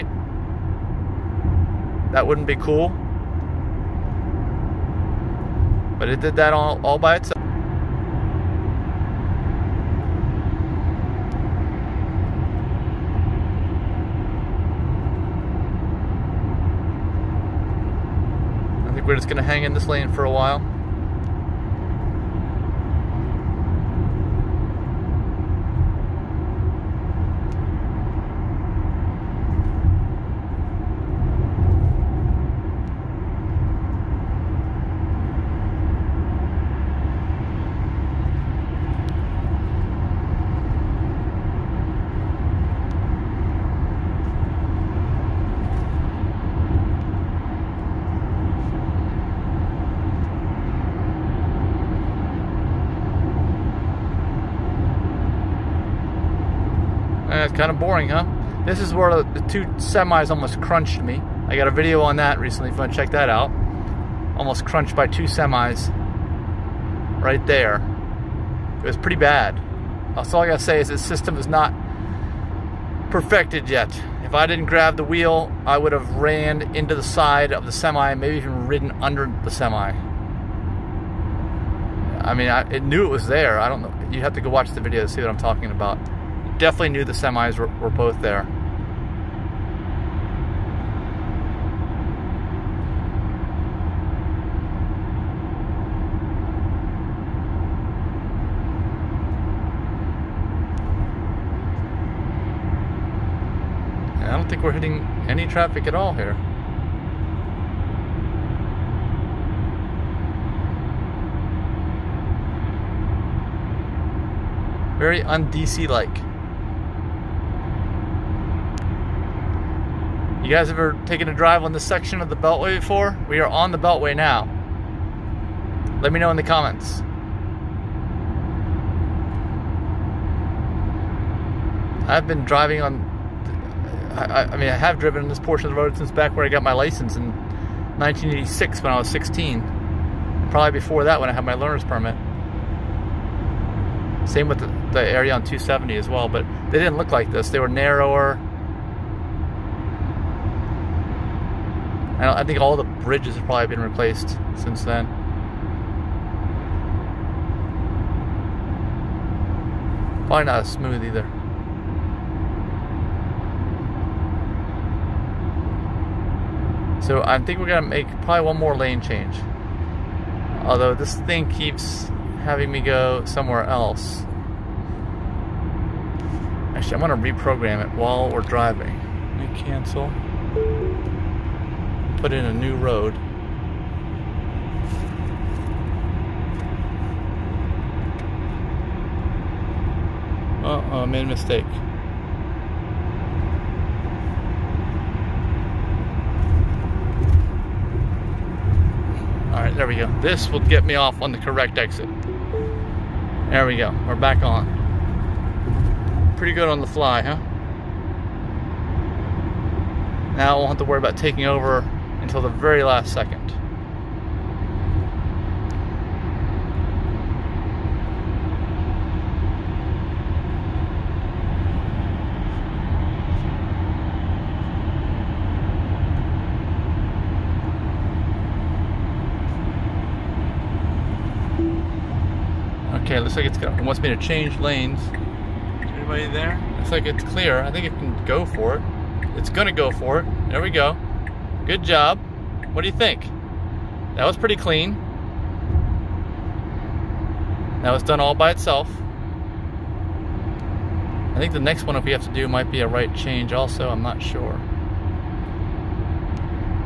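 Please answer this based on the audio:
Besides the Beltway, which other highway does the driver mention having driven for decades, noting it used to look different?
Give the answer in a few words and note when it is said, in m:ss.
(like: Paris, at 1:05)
270, at 2:25.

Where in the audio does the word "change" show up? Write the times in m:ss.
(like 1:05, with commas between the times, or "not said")
2:49, 3:54, 4:13.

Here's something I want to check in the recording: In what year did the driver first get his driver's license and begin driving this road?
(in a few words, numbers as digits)
1986.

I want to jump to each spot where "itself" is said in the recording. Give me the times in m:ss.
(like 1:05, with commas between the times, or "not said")
0:07, 4:08.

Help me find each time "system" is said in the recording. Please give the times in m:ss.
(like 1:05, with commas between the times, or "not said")
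1:11.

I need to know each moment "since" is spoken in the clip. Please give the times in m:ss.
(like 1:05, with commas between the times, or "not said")
2:15, 2:34.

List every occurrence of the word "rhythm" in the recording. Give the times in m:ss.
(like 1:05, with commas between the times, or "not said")
not said.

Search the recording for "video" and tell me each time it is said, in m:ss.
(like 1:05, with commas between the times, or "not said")
1:01, 1:24.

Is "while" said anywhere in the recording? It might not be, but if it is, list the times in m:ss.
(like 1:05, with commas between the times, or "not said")
0:20, 2:57.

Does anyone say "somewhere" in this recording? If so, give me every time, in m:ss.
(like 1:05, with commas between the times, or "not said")
2:53.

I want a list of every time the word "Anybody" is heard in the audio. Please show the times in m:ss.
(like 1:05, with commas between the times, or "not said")
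3:55.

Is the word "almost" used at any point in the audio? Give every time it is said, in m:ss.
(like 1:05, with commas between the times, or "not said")
1:00, 1:04.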